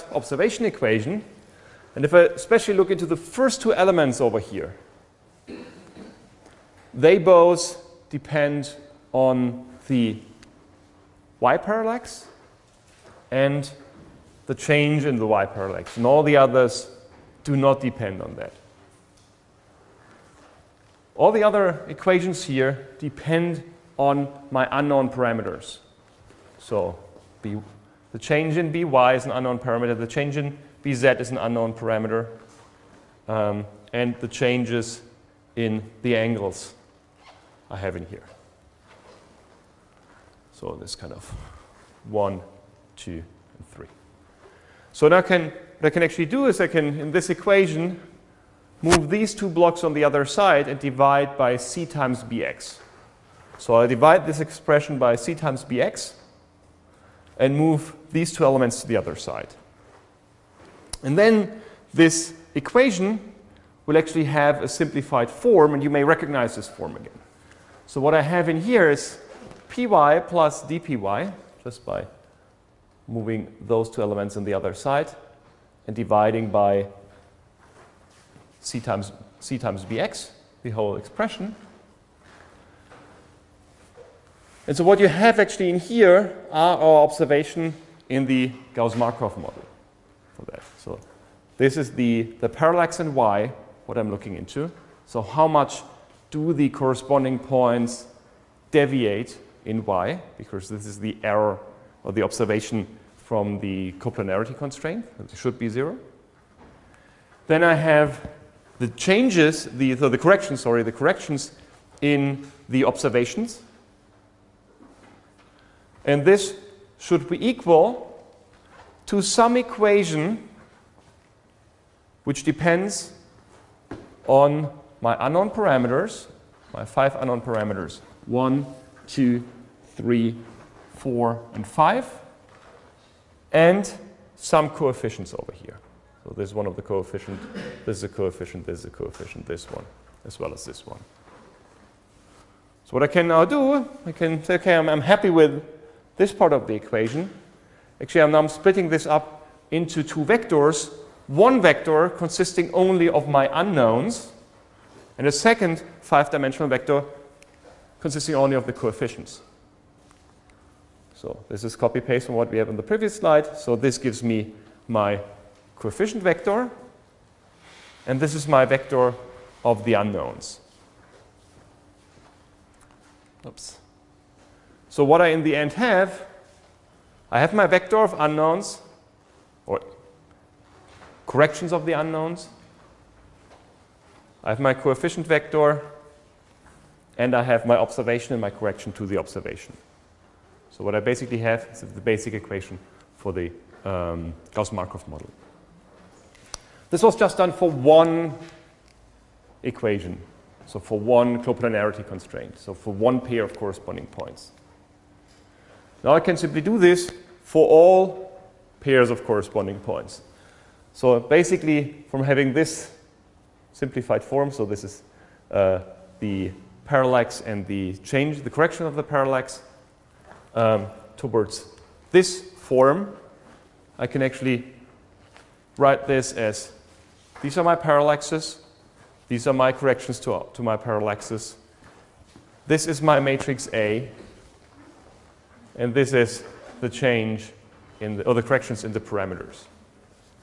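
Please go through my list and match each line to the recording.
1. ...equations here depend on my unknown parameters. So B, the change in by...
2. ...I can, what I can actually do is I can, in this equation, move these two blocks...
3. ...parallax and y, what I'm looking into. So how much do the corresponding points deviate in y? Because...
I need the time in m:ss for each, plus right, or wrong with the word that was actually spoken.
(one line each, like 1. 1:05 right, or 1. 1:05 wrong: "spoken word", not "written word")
1. 0:21 right
2. 0:45 right
3. 1:32 right.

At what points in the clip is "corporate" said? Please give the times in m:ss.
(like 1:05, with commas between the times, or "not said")
not said.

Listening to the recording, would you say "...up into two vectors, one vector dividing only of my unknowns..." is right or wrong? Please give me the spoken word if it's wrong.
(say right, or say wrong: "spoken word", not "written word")
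wrong: "consisting", not "dividing".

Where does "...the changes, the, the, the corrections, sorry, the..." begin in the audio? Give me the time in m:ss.
1:48.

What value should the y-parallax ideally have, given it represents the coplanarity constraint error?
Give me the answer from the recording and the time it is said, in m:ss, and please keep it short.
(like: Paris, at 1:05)
0, at 1:45.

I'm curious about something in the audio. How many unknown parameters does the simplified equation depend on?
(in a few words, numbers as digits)
5.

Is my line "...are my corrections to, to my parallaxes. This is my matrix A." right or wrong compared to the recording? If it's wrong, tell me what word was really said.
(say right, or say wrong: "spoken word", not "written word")
right.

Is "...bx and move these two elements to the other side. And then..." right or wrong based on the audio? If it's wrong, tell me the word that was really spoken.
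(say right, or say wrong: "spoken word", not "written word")
right.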